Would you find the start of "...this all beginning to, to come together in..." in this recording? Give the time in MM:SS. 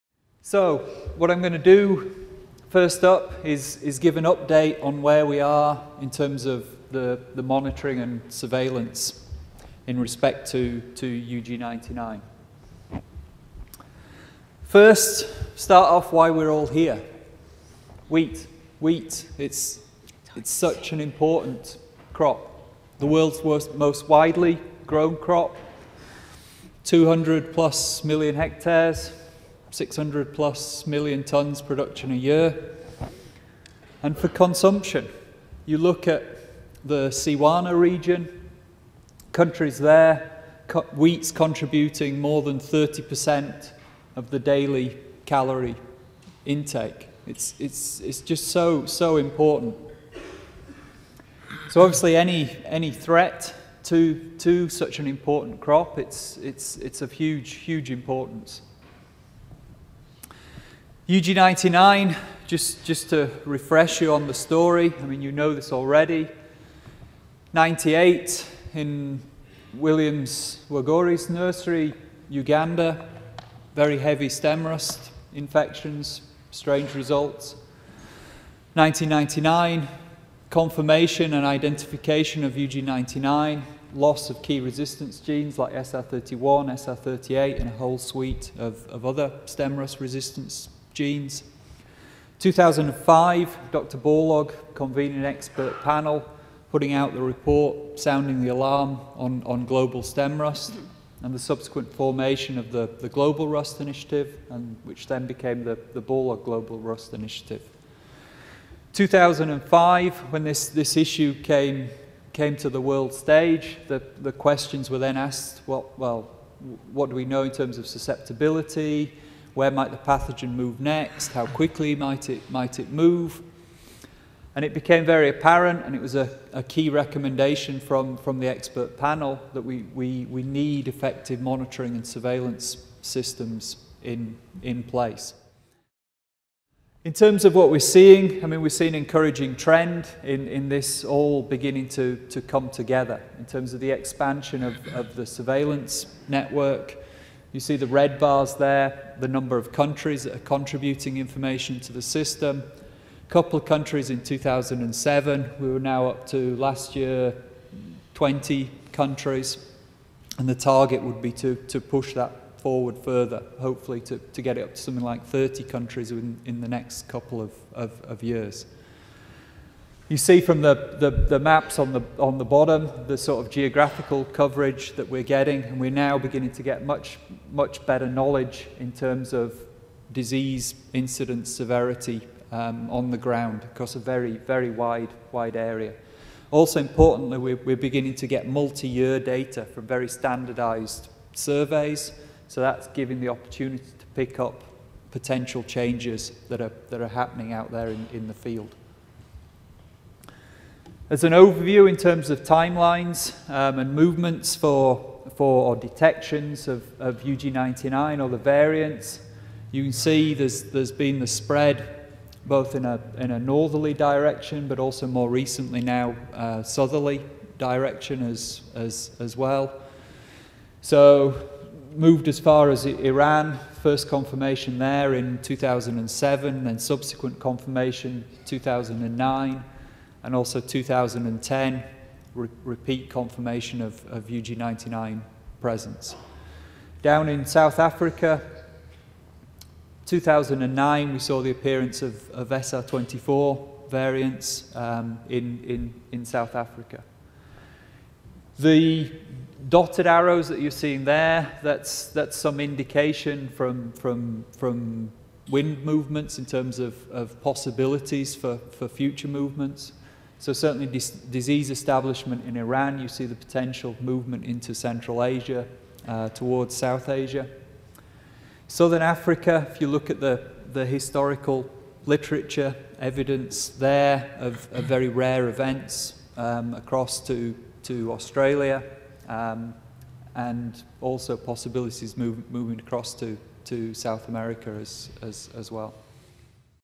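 02:20.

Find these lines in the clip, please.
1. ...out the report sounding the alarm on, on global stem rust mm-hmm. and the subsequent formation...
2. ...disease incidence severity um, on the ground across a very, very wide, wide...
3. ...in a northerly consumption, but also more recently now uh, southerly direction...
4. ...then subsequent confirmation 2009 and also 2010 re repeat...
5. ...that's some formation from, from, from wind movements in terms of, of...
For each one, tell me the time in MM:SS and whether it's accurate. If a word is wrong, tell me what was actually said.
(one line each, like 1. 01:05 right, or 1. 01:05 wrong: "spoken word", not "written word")
1. 01:36 right
2. 03:00 right
3. 03:33 wrong: "direction", not "consumption"
4. 03:46 right
5. 04:12 wrong: "indication", not "formation".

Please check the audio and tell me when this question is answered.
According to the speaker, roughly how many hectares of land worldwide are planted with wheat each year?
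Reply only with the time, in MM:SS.
00:26.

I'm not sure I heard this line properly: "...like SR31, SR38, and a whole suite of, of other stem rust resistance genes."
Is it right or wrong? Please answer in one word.
right.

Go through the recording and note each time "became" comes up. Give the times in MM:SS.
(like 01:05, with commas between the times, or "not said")
01:45, 02:04.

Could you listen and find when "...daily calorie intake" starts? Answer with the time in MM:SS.
00:44.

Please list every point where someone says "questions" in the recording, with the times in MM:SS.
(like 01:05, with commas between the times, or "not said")
01:54.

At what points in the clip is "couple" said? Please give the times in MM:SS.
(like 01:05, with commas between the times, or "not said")
02:33, 02:47.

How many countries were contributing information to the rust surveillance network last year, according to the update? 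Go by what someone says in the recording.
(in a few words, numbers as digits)
20.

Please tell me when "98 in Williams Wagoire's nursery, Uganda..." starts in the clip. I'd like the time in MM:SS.
01:07.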